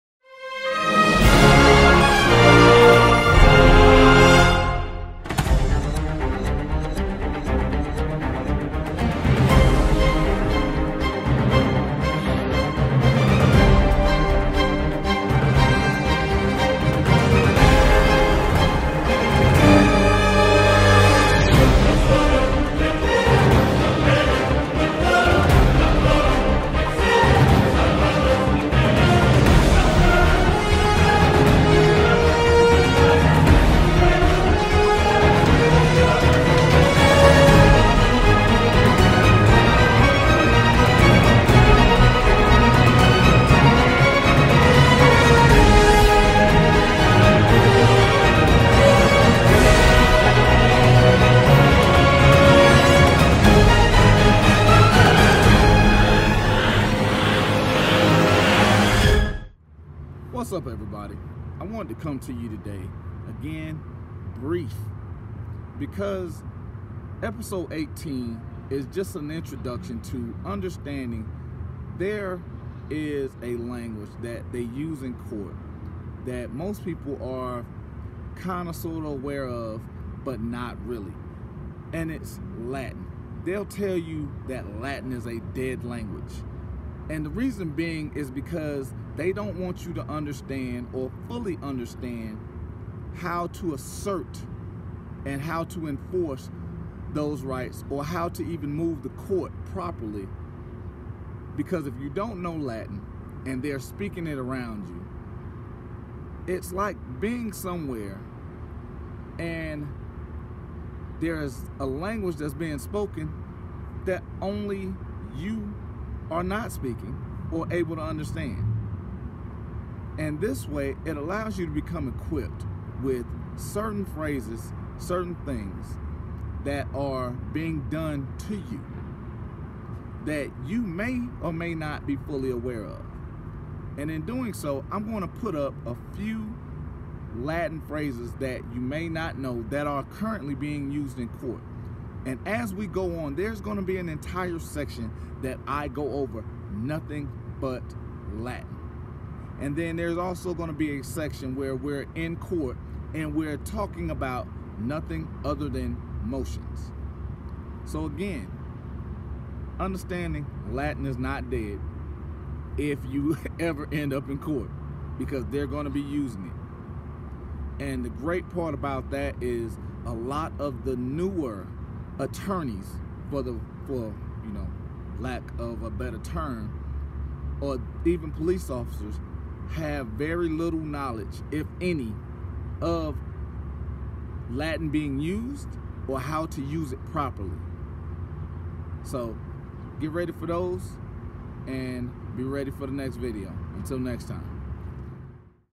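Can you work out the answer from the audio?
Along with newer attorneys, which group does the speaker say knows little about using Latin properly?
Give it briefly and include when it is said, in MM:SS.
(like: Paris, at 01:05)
Police officers, at 02:58.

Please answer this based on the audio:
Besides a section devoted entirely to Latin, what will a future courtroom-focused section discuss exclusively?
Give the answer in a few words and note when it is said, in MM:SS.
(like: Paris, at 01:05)
Motions, at 02:36.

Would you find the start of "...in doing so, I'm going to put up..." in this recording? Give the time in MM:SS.
02:14.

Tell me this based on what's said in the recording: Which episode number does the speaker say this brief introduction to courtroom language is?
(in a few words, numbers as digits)
18.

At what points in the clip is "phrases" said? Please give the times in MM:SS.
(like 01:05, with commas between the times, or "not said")
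02:04, 02:17.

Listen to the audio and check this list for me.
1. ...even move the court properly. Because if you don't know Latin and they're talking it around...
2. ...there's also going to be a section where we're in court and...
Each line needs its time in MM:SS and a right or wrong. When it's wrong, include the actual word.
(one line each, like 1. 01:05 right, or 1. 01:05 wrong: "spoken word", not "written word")
1. 01:38 wrong: "speaking", not "talking"
2. 02:29 right.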